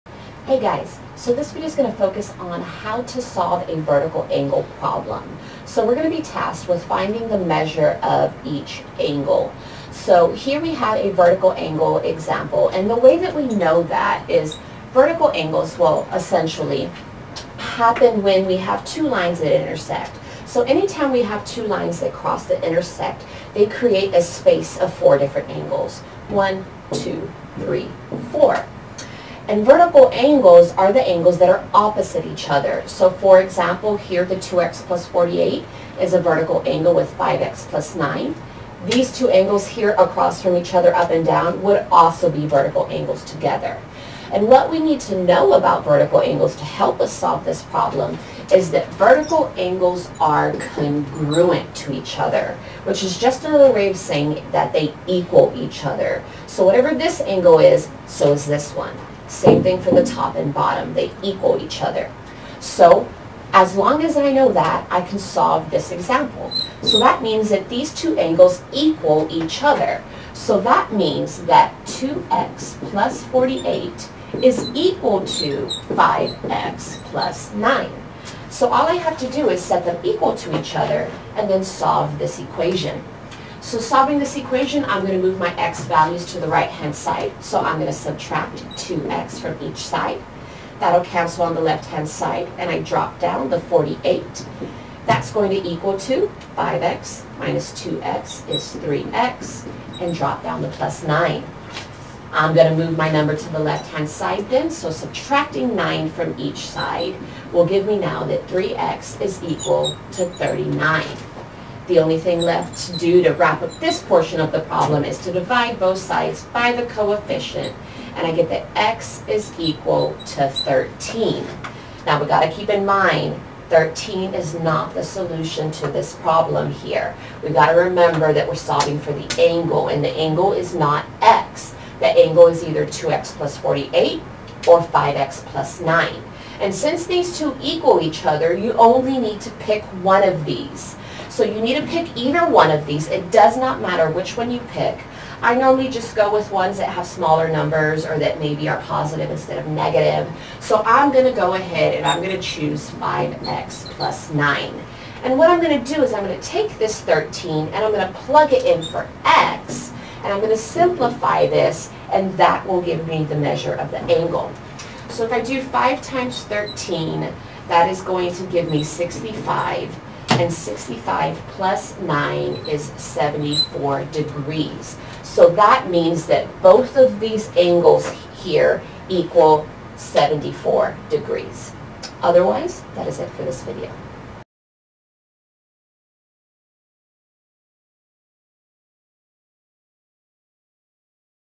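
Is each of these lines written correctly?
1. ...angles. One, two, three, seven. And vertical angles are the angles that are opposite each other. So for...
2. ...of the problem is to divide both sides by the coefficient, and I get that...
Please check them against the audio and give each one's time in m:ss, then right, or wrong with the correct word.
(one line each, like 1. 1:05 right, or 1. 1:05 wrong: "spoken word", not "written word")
1. 0:25 wrong: "four", not "seven"
2. 1:54 right.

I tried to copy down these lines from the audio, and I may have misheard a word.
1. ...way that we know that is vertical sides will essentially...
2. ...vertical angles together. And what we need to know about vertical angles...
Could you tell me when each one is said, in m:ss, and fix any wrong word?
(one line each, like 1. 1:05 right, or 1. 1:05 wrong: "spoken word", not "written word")
1. 0:12 wrong: "angles", not "sides"
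2. 0:42 right.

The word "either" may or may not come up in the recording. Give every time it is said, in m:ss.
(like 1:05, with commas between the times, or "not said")
2:12, 2:22.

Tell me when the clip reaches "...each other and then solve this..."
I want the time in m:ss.
1:20.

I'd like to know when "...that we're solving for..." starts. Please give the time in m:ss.
2:08.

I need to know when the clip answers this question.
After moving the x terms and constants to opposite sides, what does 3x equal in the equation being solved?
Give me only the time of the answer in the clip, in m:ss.
1:50.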